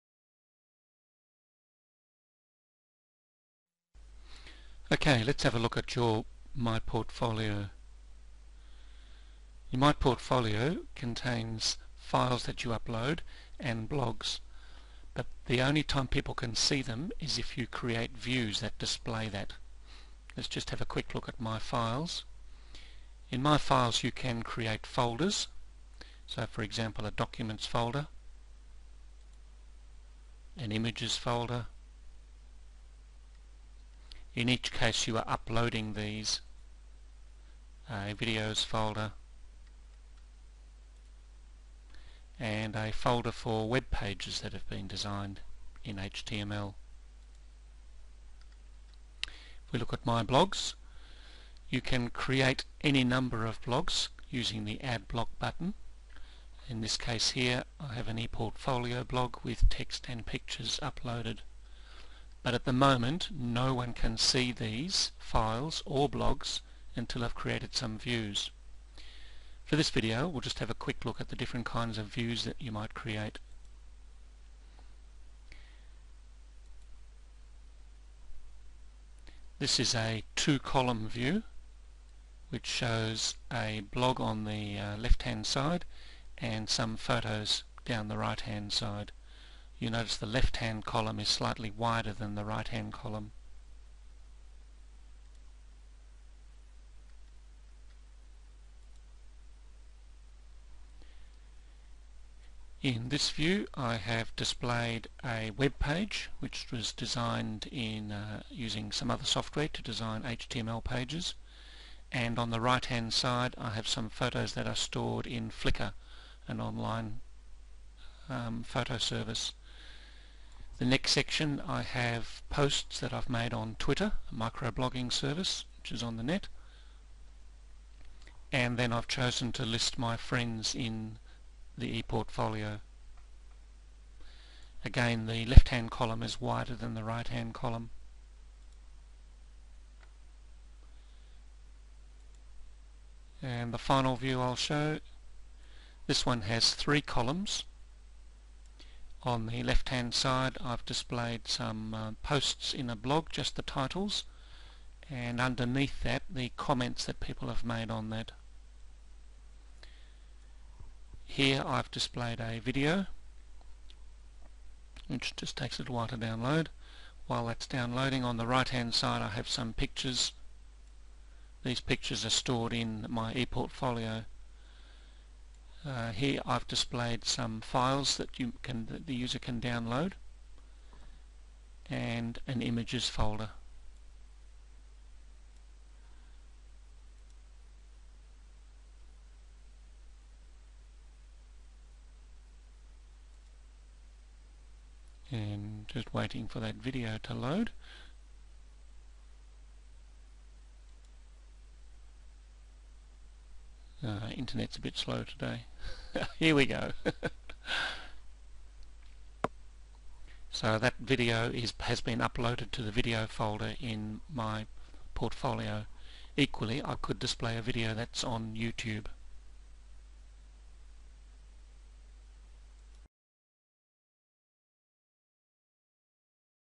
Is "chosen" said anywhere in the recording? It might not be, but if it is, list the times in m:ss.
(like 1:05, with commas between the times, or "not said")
2:09.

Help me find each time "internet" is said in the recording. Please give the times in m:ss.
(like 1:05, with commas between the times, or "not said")
3:24.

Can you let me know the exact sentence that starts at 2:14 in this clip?
Again the left hand column is wider than the right hand column.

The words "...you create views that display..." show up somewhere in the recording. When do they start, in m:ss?
0:17.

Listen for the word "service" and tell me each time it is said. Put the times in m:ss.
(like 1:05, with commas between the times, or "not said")
1:58, 2:05.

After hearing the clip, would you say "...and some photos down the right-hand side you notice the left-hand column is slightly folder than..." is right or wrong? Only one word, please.
wrong.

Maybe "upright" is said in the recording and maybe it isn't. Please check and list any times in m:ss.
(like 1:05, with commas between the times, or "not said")
not said.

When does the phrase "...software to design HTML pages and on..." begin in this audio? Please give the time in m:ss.
1:49.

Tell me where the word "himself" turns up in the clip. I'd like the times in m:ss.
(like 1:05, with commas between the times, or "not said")
not said.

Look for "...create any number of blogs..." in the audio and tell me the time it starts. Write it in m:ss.
0:52.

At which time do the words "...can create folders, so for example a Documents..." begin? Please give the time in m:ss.
0:24.